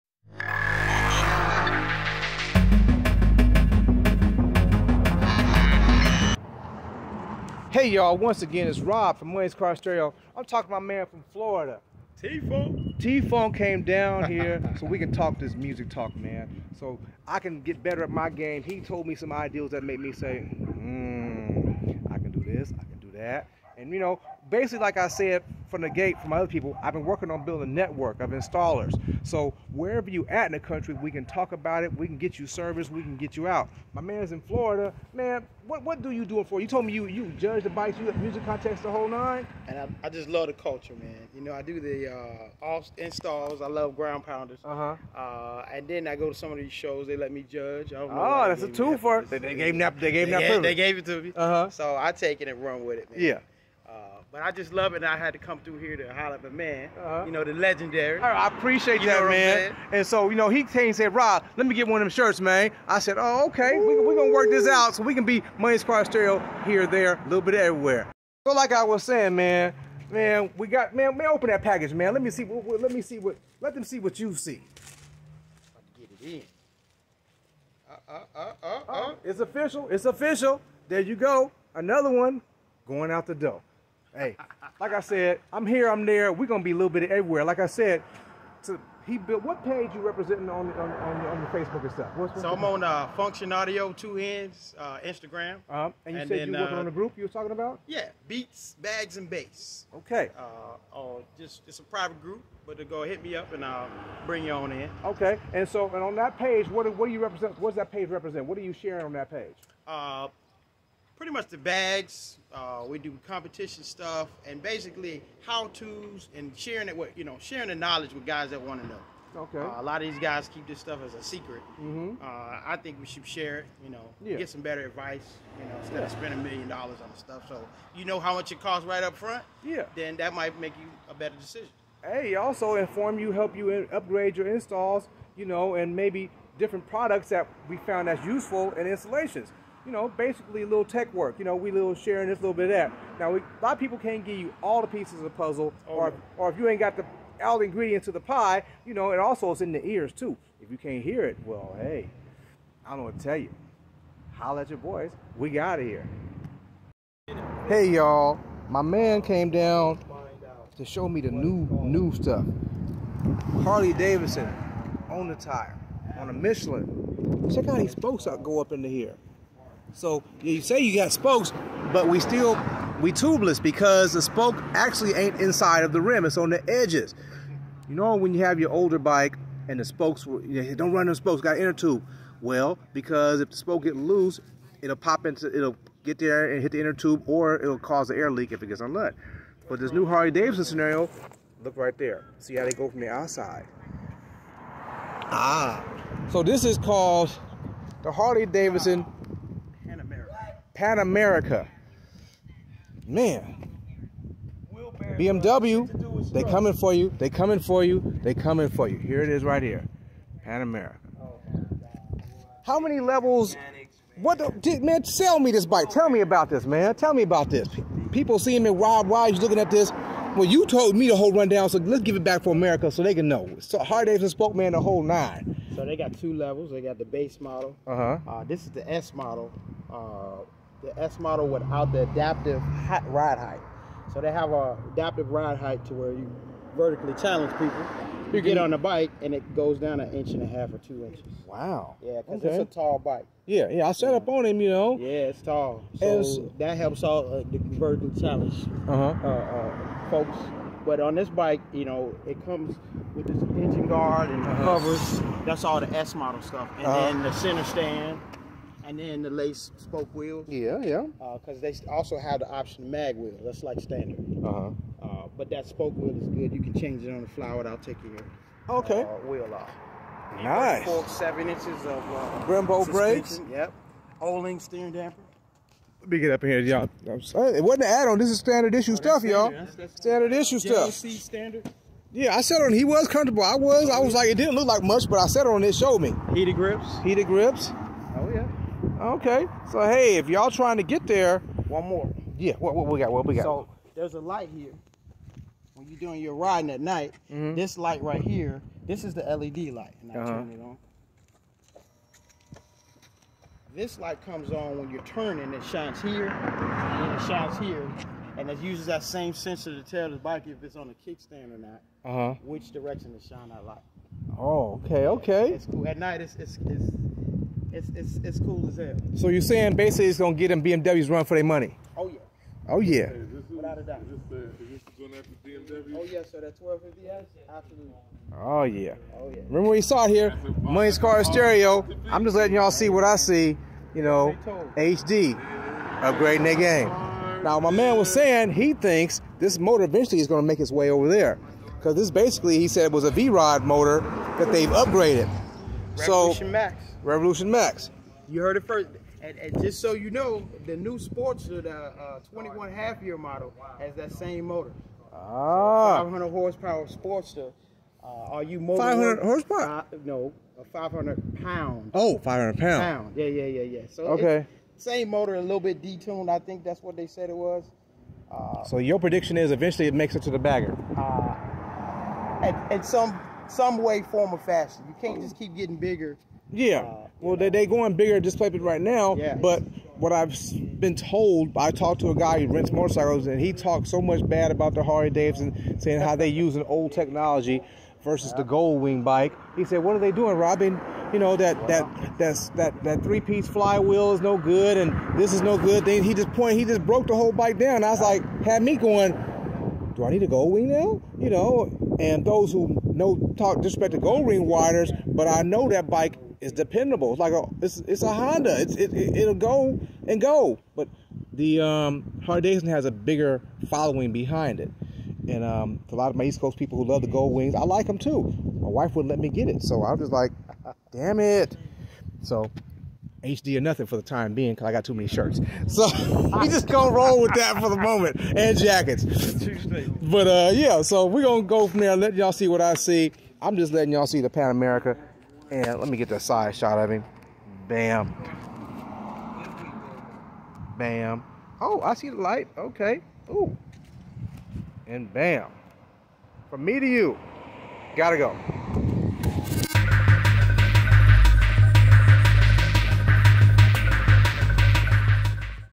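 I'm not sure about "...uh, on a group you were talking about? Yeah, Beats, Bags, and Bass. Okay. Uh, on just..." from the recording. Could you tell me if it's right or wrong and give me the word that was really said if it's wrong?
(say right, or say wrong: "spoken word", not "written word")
right.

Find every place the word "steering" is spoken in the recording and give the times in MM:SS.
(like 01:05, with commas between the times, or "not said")
04:34.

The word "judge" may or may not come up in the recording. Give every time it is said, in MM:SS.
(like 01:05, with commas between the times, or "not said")
00:37, 00:47.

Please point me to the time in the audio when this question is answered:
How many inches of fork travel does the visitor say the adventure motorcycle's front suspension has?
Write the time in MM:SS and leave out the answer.
04:31.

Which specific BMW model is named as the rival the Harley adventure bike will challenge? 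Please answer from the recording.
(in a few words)
1250S.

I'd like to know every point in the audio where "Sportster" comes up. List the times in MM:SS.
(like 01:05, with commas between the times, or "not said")
05:50, 05:56.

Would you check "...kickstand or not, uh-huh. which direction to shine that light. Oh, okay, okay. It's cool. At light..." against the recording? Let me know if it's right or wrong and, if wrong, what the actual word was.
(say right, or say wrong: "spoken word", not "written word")
wrong: "night", not "light".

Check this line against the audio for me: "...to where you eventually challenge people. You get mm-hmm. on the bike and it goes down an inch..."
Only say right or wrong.
wrong.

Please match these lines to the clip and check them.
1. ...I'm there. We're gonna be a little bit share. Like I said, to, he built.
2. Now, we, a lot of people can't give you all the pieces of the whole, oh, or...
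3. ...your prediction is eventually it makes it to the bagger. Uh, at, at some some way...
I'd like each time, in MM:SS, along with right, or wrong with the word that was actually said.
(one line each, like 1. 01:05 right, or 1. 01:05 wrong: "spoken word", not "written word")
1. 01:25 wrong: "everywhere", not "share"
2. 02:23 wrong: "puzzle", not "whole"
3. 06:08 right.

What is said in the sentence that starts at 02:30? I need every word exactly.
If you can't hear it, well, hey, I don't know what to tell you.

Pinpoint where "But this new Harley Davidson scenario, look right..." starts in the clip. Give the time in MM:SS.
03:09.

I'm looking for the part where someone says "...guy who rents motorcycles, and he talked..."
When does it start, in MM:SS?
06:22.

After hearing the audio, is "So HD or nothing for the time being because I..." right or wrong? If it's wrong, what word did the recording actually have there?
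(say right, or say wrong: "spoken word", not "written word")
right.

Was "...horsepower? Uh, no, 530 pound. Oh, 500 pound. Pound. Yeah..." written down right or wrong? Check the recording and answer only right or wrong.
wrong.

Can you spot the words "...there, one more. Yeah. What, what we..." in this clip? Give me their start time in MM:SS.
04:51.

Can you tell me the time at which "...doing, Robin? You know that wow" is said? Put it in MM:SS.
06:30.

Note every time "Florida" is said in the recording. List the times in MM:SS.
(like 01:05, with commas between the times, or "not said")
00:11, 00:34.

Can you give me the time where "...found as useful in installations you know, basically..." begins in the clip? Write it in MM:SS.
02:17.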